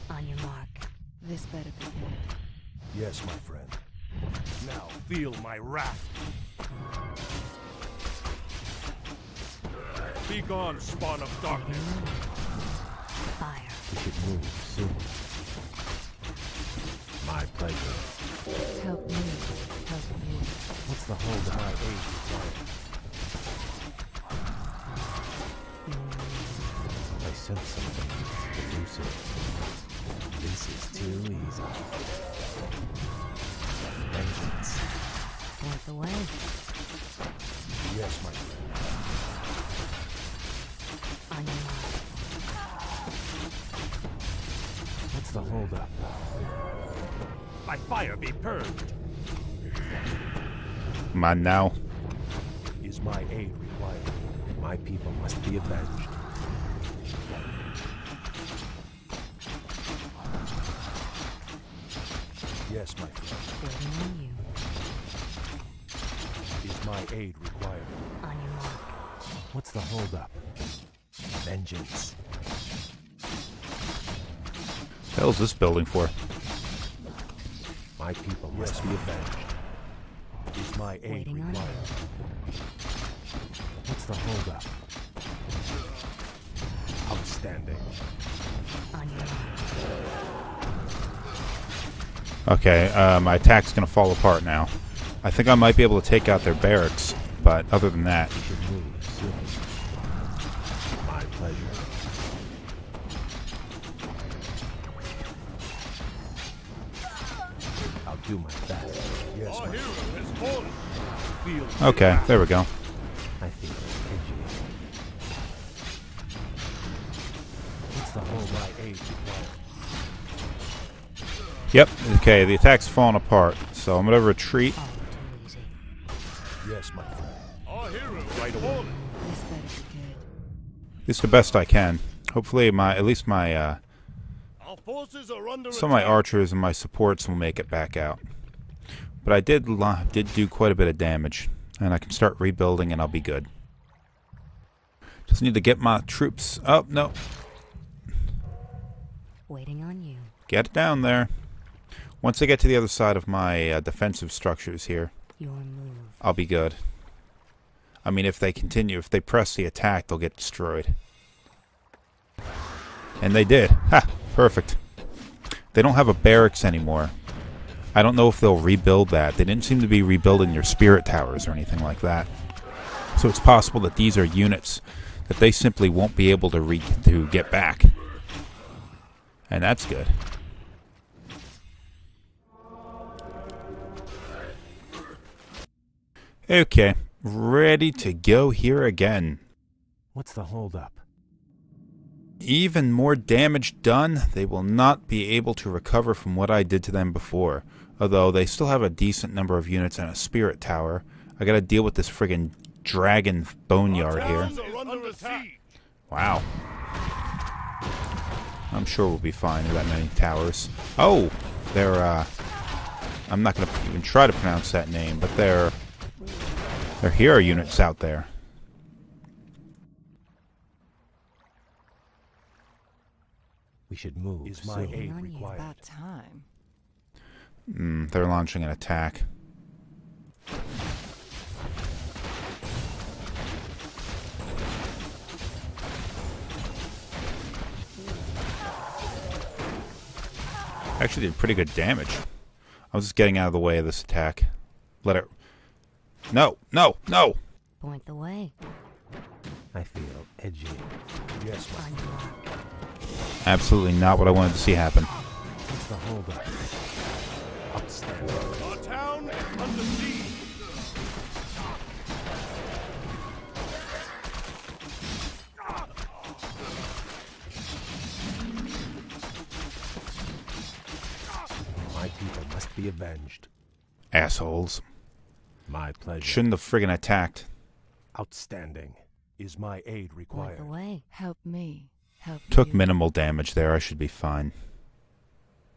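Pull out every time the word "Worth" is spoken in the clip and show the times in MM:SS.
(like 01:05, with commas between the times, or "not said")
00:35.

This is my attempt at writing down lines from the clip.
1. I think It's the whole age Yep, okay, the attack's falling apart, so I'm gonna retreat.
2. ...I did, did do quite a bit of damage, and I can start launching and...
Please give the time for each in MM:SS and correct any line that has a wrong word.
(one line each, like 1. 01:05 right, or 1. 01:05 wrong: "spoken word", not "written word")
1. 01:53 right
2. 02:19 wrong: "rebuilding", not "launching".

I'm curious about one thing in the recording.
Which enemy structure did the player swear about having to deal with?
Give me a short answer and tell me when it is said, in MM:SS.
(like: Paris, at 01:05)
dragon boneyard, at 03:22.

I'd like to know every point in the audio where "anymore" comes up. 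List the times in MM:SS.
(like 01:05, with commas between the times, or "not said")
02:46.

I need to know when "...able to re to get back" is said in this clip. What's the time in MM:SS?
02:56.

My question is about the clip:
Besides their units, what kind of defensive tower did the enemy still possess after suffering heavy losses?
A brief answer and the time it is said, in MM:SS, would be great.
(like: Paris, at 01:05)
spirit tower, at 03:20.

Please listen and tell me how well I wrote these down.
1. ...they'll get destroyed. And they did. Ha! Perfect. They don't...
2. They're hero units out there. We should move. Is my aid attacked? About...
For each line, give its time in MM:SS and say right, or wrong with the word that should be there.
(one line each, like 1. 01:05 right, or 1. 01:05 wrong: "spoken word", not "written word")
1. 02:40 right
2. 03:36 wrong: "required", not "attacked".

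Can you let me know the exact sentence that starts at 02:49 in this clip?
They didn't seem to be rebuilding your spirit towers or anything like that.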